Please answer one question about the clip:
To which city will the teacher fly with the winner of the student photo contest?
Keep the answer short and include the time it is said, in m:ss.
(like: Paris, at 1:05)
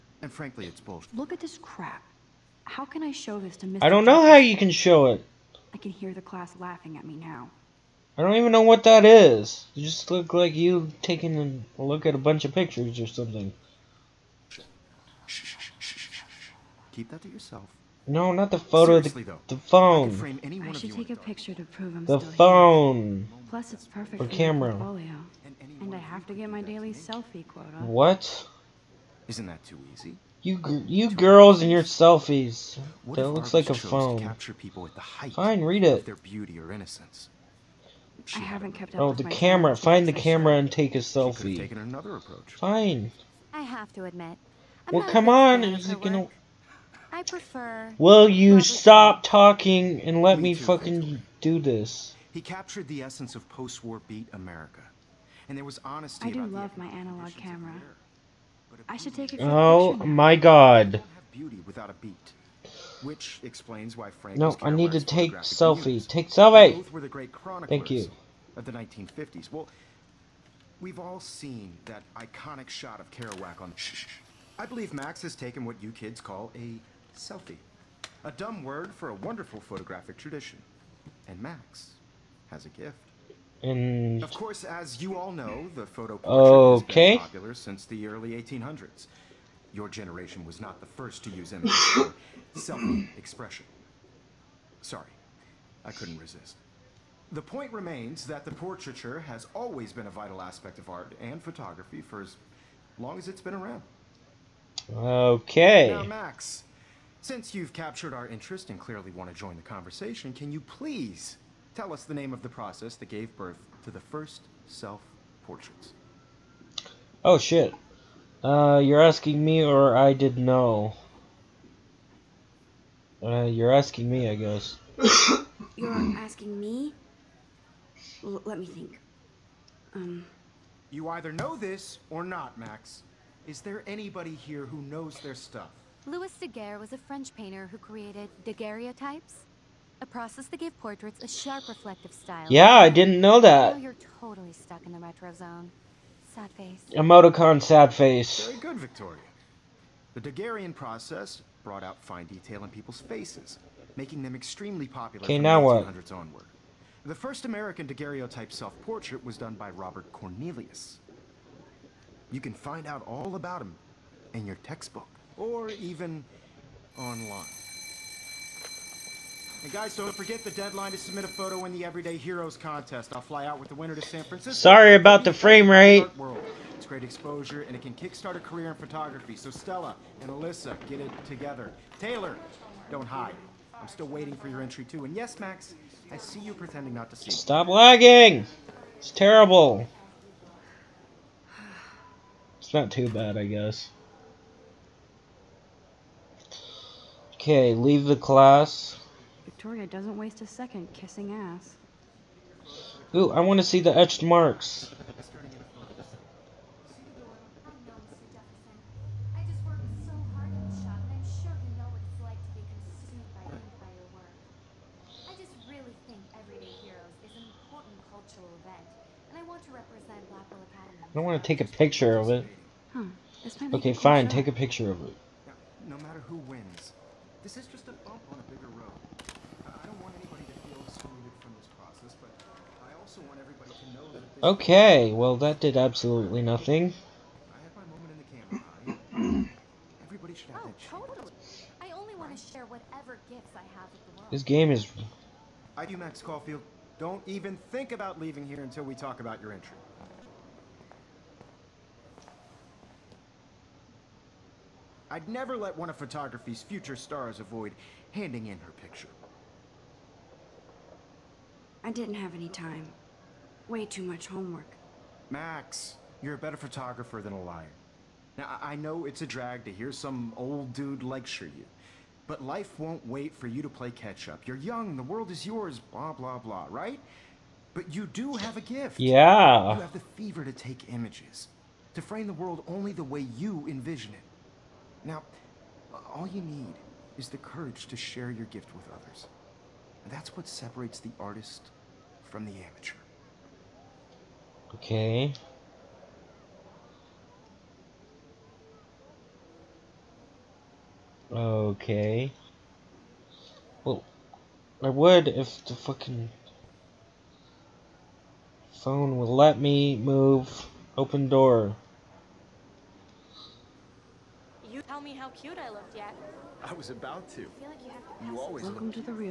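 San Francisco, at 2:54.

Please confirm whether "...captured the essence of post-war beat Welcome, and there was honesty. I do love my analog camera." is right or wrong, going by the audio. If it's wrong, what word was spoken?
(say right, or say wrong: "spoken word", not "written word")
wrong: "America", not "Welcome".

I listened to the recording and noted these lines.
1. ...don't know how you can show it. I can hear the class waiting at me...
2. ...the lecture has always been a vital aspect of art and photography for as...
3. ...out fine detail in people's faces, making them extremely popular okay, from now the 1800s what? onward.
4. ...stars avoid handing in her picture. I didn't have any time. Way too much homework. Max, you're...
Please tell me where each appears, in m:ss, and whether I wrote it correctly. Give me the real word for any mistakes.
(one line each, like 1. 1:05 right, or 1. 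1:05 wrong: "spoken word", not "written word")
1. 0:03 wrong: "laughing", not "waiting"
2. 1:38 wrong: "portraiture", not "lecture"
3. 2:31 right
4. 4:16 right.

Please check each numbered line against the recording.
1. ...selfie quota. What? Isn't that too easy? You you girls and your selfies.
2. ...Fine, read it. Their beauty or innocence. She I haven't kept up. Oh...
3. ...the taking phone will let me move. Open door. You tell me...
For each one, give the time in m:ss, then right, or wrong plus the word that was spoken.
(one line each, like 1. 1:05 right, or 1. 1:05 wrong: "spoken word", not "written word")
1. 0:26 right
2. 0:35 right
3. 5:05 wrong: "fucking", not "taking".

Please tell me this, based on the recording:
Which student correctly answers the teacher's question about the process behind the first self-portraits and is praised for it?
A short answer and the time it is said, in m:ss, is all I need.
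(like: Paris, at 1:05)
Victoria, at 2:28.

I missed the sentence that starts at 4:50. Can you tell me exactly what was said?
And that's what separates the artist from the amateur.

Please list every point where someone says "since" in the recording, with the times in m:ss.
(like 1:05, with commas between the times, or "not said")
1:27, 1:47.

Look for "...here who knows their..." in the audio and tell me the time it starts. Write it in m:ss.
2:14.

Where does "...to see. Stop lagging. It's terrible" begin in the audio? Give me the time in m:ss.
3:07.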